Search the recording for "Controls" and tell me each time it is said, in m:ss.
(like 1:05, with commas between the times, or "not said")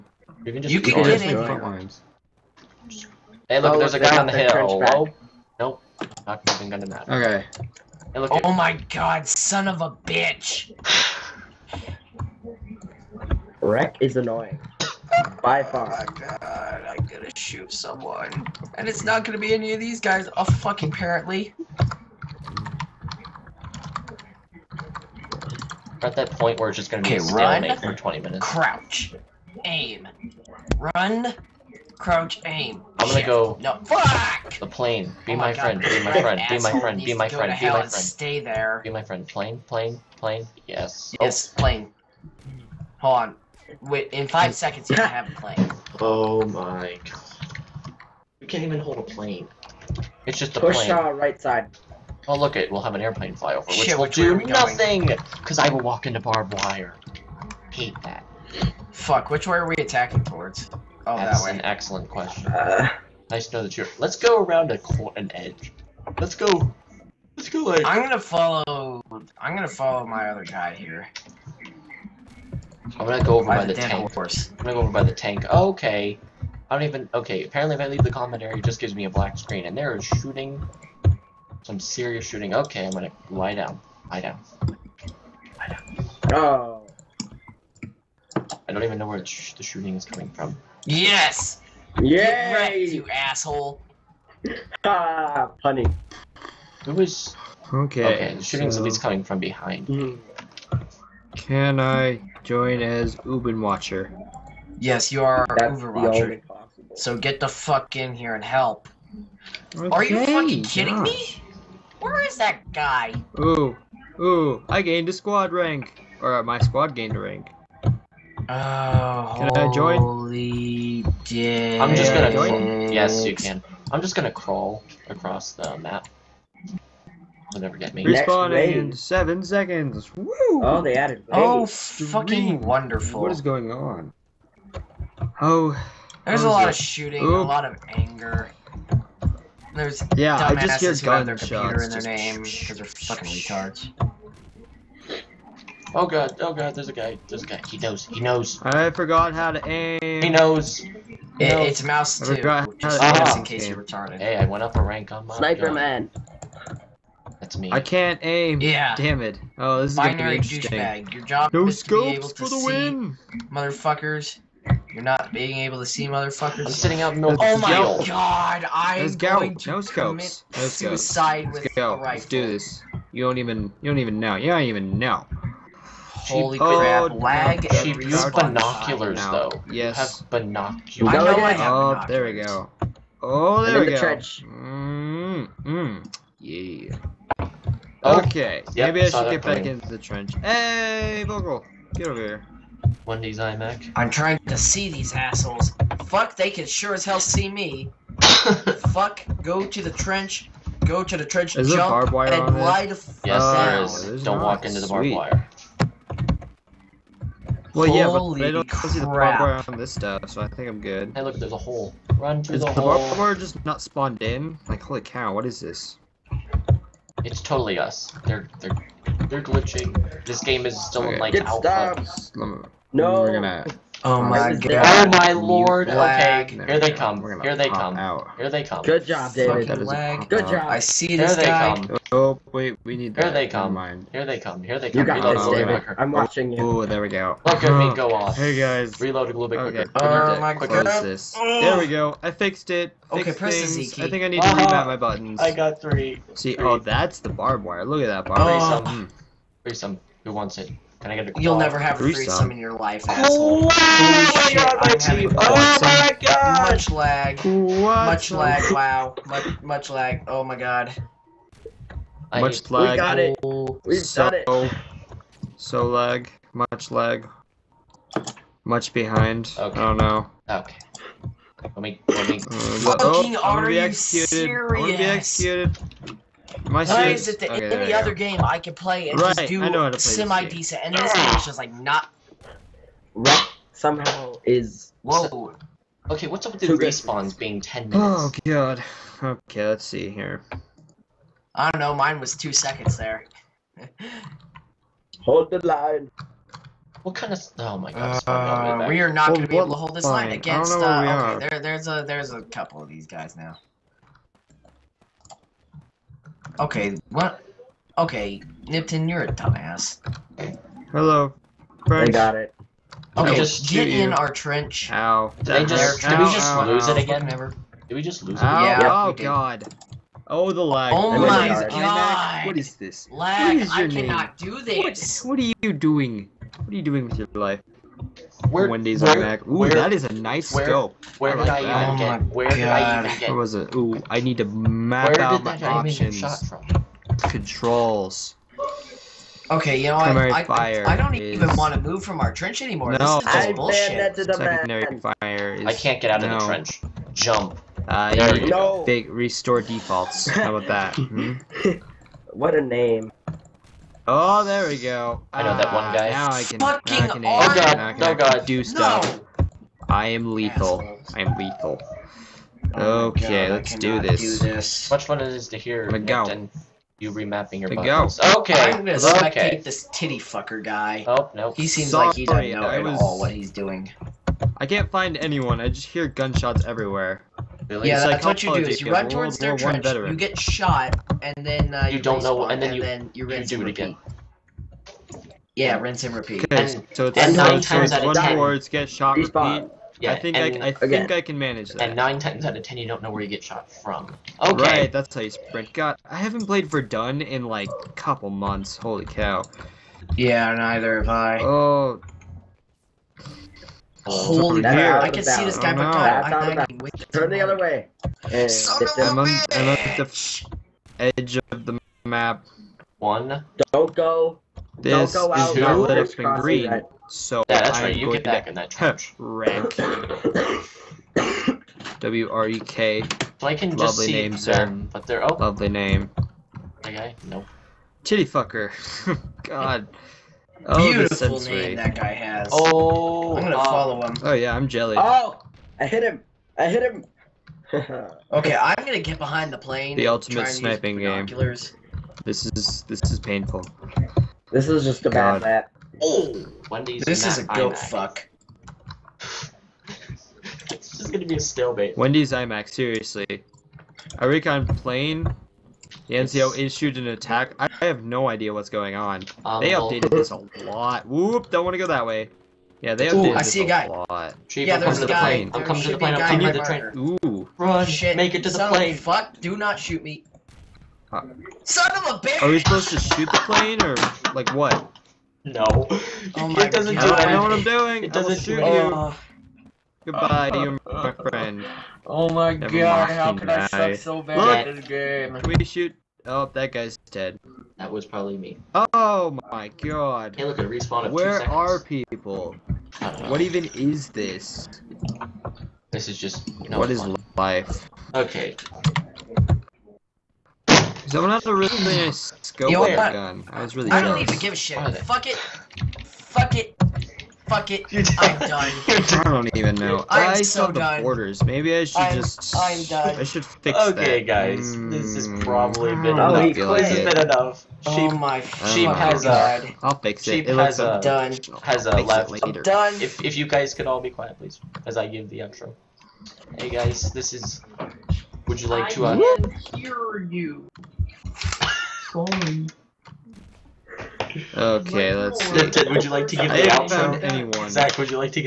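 5:37.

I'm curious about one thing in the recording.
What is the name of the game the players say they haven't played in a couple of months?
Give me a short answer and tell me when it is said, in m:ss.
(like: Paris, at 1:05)
Verdun, at 6:36.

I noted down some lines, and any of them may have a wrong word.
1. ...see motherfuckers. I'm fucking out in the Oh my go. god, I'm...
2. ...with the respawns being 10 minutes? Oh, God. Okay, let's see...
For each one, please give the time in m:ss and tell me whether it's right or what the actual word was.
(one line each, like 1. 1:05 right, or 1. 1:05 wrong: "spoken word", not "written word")
1. 2:45 wrong: "sitting", not "fucking"
2. 4:46 right.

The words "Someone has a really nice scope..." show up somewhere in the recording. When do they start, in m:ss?
8:21.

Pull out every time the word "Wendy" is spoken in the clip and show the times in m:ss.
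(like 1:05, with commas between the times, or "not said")
3:13, 5:28, 7:31.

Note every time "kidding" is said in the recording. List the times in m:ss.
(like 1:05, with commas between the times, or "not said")
1:50.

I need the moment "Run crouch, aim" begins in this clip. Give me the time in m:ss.
0:30.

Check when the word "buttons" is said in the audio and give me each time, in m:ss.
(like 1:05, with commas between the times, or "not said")
4:04, 6:07.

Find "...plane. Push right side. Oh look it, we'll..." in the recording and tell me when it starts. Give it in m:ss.
0:50.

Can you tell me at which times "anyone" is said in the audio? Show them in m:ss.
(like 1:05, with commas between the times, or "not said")
6:15, 8:57.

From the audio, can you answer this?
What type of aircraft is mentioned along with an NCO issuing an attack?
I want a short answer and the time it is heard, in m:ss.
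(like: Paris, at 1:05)
Recon plane, at 7:34.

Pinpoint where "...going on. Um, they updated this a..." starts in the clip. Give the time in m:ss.
7:38.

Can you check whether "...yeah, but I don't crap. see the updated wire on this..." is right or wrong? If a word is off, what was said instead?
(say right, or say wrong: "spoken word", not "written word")
wrong: "barbed", not "updated".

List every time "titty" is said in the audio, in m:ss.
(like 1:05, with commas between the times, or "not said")
6:09, 7:08.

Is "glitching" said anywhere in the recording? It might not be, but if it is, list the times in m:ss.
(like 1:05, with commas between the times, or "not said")
3:39.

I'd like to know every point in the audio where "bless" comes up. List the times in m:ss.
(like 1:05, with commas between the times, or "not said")
not said.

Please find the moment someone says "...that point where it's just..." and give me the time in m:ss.
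0:26.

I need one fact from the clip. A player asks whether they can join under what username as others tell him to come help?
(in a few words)
Ubin Watcher.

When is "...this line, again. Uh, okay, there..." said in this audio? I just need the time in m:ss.
4:59.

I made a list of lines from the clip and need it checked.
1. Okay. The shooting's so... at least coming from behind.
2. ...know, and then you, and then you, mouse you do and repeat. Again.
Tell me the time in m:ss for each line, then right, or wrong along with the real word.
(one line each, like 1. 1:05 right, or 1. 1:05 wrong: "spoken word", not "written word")
1. 1:38 right
2. 6:22 wrong: "rinse", not "mouse".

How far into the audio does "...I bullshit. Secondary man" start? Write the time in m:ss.
5:43.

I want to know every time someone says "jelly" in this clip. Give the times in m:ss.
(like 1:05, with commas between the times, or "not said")
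7:14.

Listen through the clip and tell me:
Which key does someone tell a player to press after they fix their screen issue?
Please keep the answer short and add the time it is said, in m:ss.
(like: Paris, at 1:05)
Z, at 4:03.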